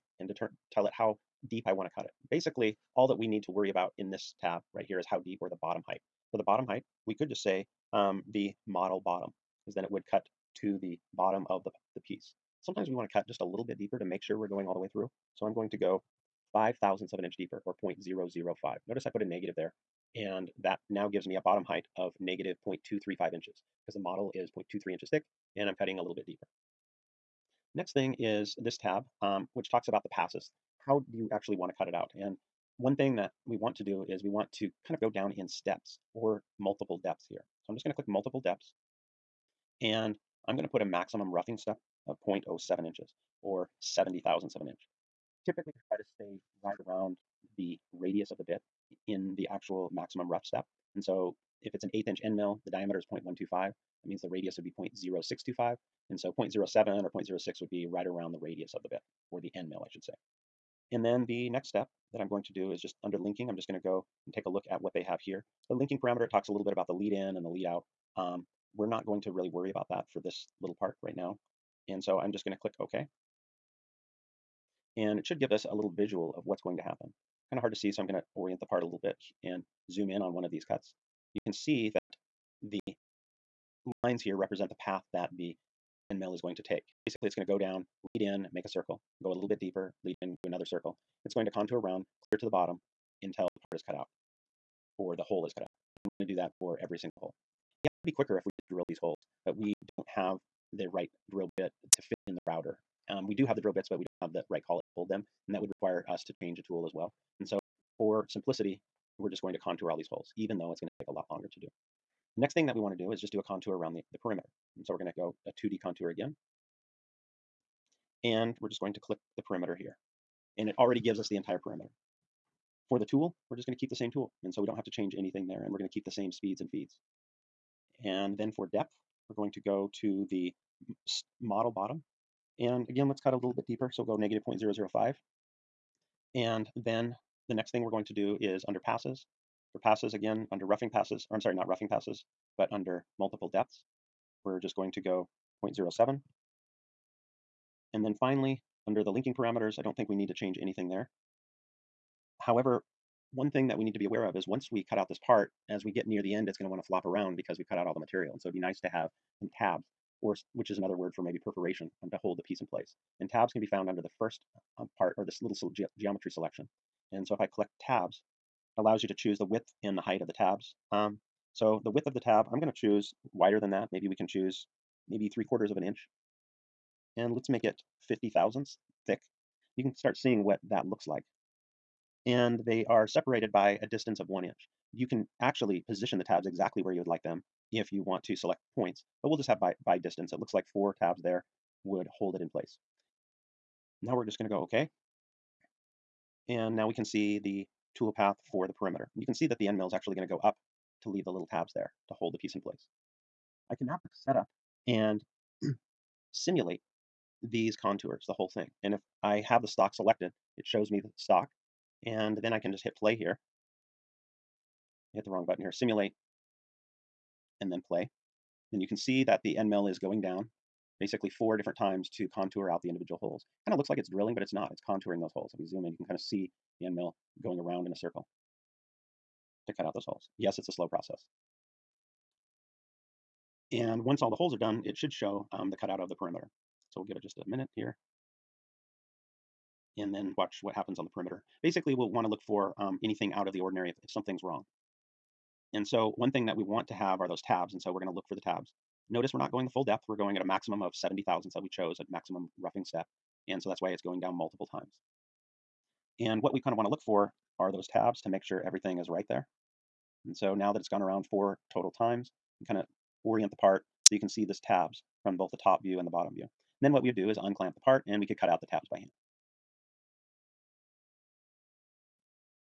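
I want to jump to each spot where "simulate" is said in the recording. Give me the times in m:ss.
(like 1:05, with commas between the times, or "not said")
3:26, 3:35.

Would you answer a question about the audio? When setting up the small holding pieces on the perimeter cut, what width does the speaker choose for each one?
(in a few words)
3/4 inch.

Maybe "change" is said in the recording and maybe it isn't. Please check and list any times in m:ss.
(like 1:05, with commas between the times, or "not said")
1:46, 2:04, 2:30.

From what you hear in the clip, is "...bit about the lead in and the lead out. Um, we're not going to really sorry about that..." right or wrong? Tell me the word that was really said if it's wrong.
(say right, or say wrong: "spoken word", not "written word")
wrong: "worry", not "sorry".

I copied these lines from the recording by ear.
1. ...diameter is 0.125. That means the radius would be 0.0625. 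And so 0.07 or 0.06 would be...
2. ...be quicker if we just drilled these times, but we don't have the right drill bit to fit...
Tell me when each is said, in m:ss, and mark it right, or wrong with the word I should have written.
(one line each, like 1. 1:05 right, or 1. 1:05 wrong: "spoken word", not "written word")
1. 0:52 right
2. 1:38 wrong: "holes", not "times".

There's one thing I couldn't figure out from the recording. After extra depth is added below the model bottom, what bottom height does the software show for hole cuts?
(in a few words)
-0.235 inches.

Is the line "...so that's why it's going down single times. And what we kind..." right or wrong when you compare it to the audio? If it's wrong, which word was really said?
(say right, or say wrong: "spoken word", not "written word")
wrong: "multiple", not "single".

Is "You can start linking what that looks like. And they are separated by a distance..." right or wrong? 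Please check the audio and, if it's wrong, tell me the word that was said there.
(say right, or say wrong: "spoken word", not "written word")
wrong: "seeing", not "linking".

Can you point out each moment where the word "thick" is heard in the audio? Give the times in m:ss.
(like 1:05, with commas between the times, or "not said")
0:25, 2:59.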